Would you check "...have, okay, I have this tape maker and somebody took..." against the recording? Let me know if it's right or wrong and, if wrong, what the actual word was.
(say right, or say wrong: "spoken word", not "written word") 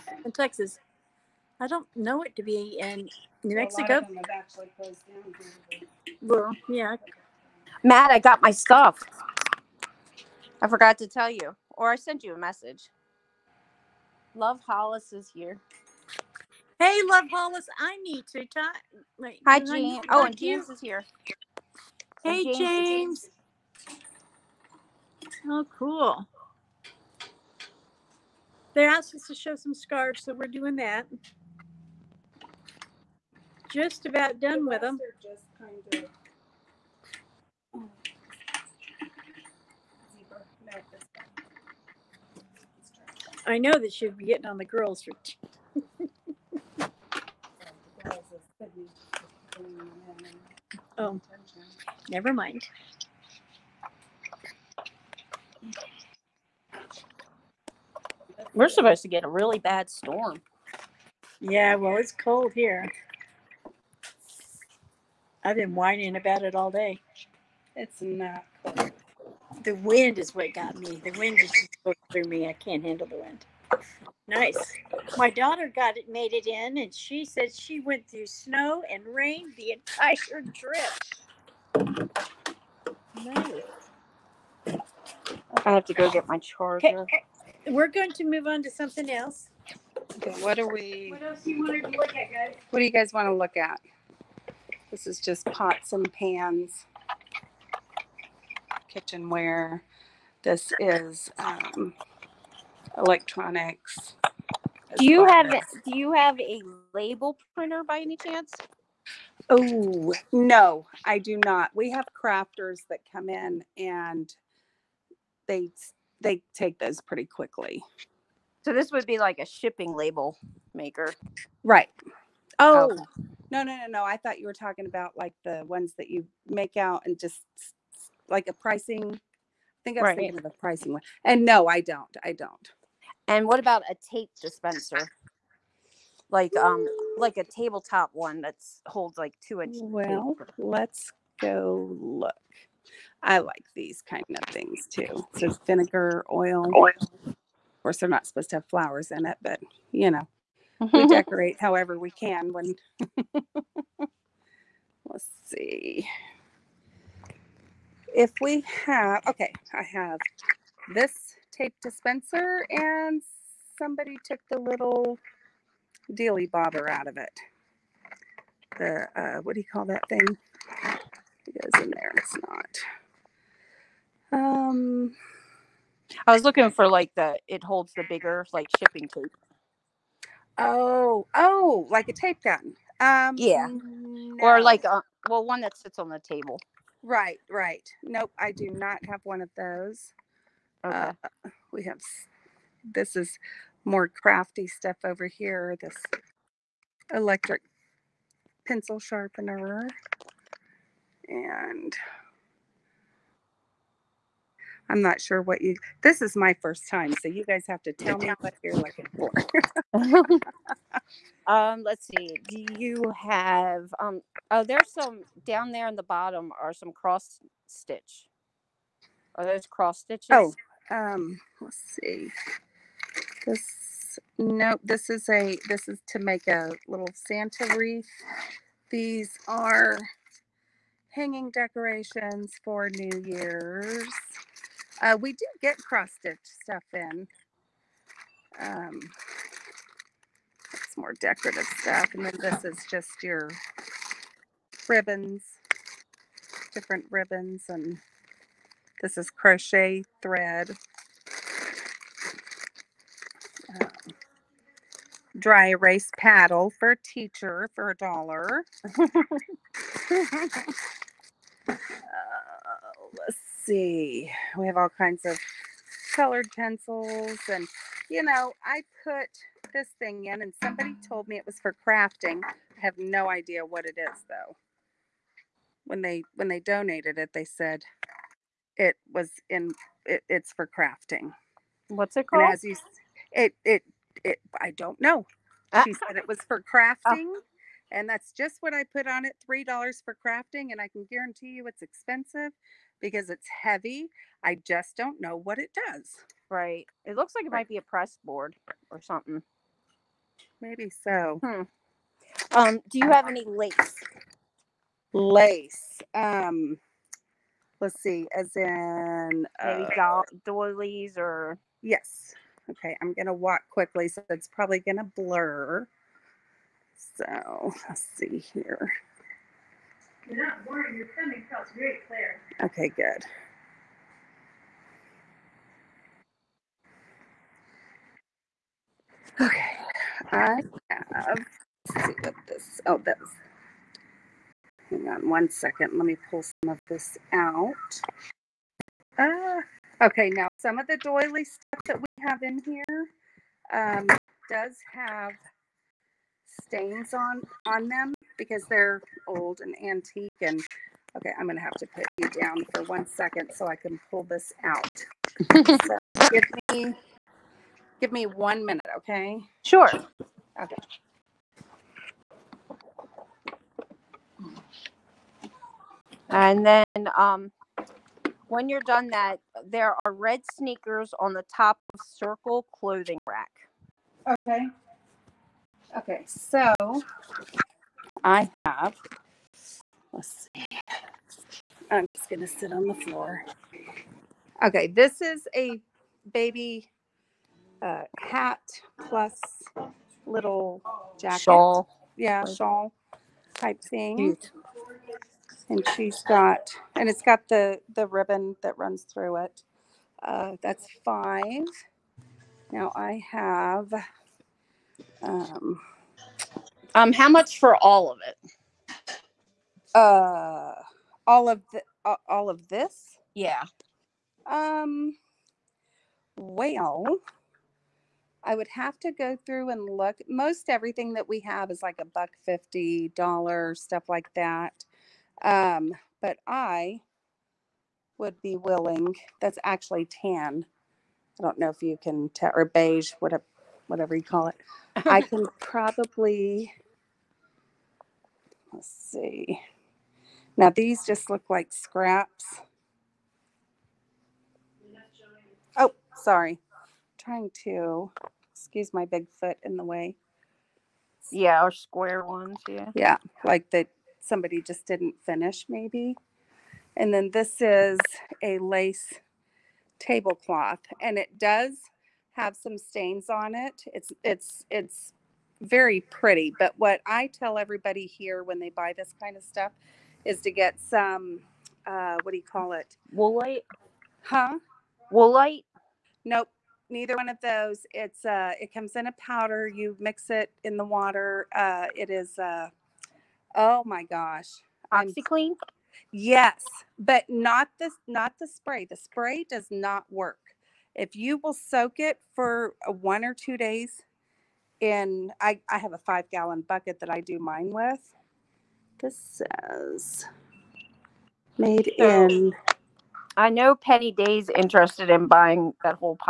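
wrong: "dispenser", not "maker".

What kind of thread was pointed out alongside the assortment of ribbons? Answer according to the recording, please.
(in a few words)
Crochet thread.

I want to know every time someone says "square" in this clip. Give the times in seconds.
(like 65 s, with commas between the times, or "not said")
451 s.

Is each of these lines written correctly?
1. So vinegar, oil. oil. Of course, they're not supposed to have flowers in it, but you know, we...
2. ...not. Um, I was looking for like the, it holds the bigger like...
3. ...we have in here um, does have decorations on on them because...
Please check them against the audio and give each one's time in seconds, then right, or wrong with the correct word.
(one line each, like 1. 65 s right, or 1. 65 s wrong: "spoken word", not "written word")
1. 145 s right
2. 174 s right
3. 341 s wrong: "stains", not "decorations".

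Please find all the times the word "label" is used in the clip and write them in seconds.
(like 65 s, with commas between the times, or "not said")
106 s, 119 s.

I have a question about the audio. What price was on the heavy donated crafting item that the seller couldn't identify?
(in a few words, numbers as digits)
$3.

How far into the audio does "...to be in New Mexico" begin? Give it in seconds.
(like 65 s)
2 s.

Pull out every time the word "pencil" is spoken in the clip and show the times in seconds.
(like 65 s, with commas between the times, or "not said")
198 s, 266 s.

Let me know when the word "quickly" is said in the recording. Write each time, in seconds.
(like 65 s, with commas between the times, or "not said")
117 s, 313 s.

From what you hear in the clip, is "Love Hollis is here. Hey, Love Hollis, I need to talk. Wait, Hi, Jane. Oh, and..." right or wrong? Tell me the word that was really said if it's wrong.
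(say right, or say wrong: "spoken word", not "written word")
right.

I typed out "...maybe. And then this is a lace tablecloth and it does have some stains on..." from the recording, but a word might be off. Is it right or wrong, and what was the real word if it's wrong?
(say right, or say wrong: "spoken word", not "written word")
right.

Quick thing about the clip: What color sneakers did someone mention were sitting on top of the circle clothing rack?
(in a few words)
Red.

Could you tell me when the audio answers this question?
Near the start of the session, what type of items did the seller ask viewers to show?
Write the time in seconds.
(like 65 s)
29 s.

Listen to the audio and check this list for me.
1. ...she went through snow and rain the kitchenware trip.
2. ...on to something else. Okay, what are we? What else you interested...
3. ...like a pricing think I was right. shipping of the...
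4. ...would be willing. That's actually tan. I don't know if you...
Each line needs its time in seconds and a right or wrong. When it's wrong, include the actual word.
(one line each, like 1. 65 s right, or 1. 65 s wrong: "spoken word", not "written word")
1. 77 s wrong: "entire", not "kitchenware"
2. 88 s wrong: "wanted", not "interested"
3. 128 s wrong: "thinking", not "shipping"
4. 428 s right.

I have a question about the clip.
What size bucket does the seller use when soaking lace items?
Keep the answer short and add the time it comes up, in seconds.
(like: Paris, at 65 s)
Five gallon, at 495 s.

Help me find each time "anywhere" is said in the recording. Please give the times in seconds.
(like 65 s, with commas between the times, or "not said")
not said.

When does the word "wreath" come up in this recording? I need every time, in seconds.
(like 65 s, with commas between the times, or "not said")
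227 s.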